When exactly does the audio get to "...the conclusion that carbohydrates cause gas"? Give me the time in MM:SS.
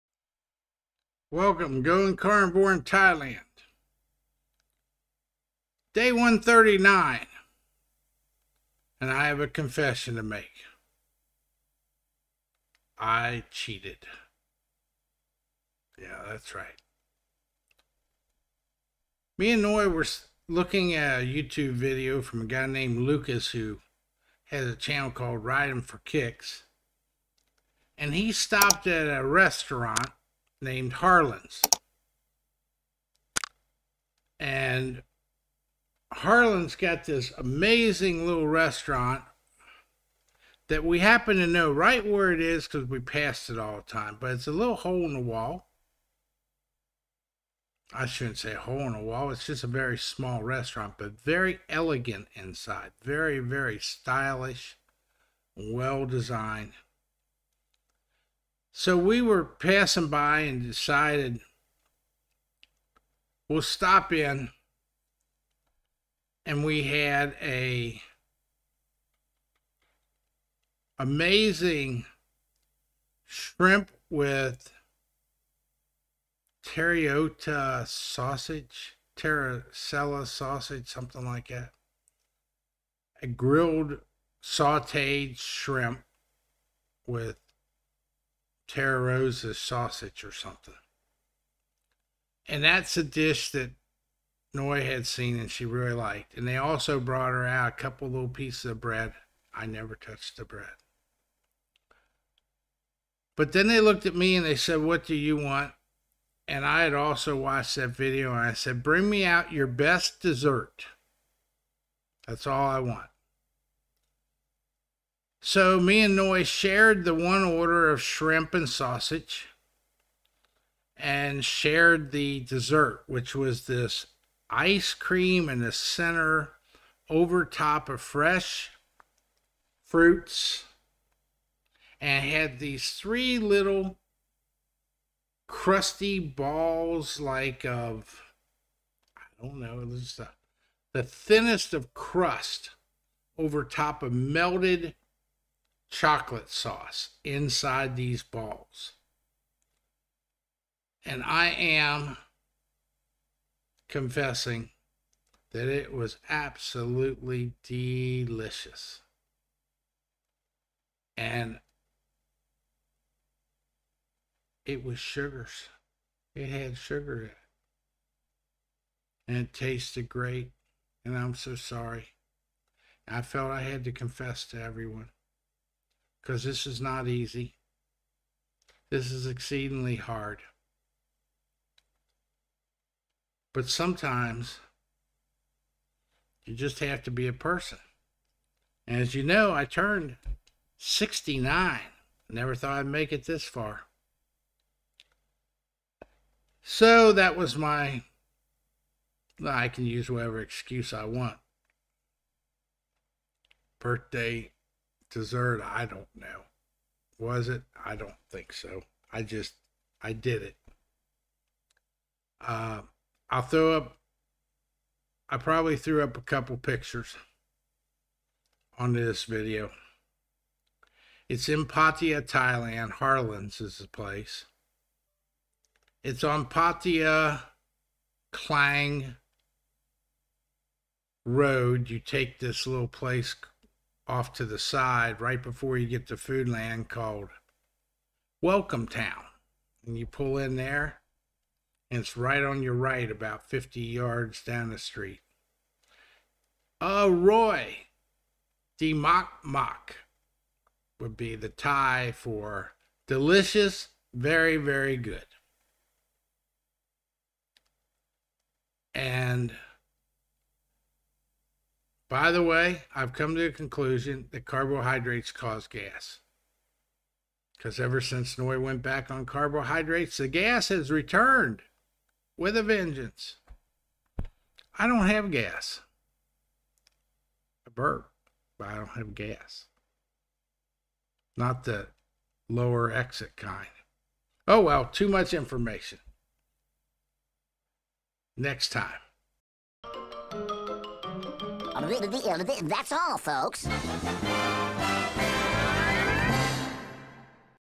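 04:23.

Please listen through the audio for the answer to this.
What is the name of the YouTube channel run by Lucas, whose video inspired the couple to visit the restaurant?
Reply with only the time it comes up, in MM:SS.
00:25.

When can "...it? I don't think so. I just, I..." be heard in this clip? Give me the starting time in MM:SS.
03:27.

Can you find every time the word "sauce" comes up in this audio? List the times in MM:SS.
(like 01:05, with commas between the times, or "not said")
02:26.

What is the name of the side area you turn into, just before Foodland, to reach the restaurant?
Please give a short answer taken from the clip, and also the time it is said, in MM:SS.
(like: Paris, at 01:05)
Welcome Town, at 03:58.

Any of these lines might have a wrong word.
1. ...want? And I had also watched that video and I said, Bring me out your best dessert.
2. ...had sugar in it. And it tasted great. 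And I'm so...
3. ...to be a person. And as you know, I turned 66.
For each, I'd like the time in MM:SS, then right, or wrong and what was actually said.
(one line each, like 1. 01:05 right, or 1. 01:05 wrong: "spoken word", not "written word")
1. 01:45 right
2. 02:46 right
3. 03:07 wrong: "69", not "66".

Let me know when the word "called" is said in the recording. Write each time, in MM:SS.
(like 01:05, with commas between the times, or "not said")
00:25, 03:56.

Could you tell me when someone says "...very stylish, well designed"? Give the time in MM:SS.
00:53.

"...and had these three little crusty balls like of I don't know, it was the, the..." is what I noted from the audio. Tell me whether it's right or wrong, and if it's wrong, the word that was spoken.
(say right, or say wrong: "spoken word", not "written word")
right.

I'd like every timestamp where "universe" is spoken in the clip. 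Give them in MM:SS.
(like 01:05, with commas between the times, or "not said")
not said.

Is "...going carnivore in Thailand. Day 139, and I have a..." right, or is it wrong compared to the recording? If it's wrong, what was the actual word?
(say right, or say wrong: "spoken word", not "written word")
right.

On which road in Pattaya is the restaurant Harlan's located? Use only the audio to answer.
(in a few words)
Pattaya Klang Road.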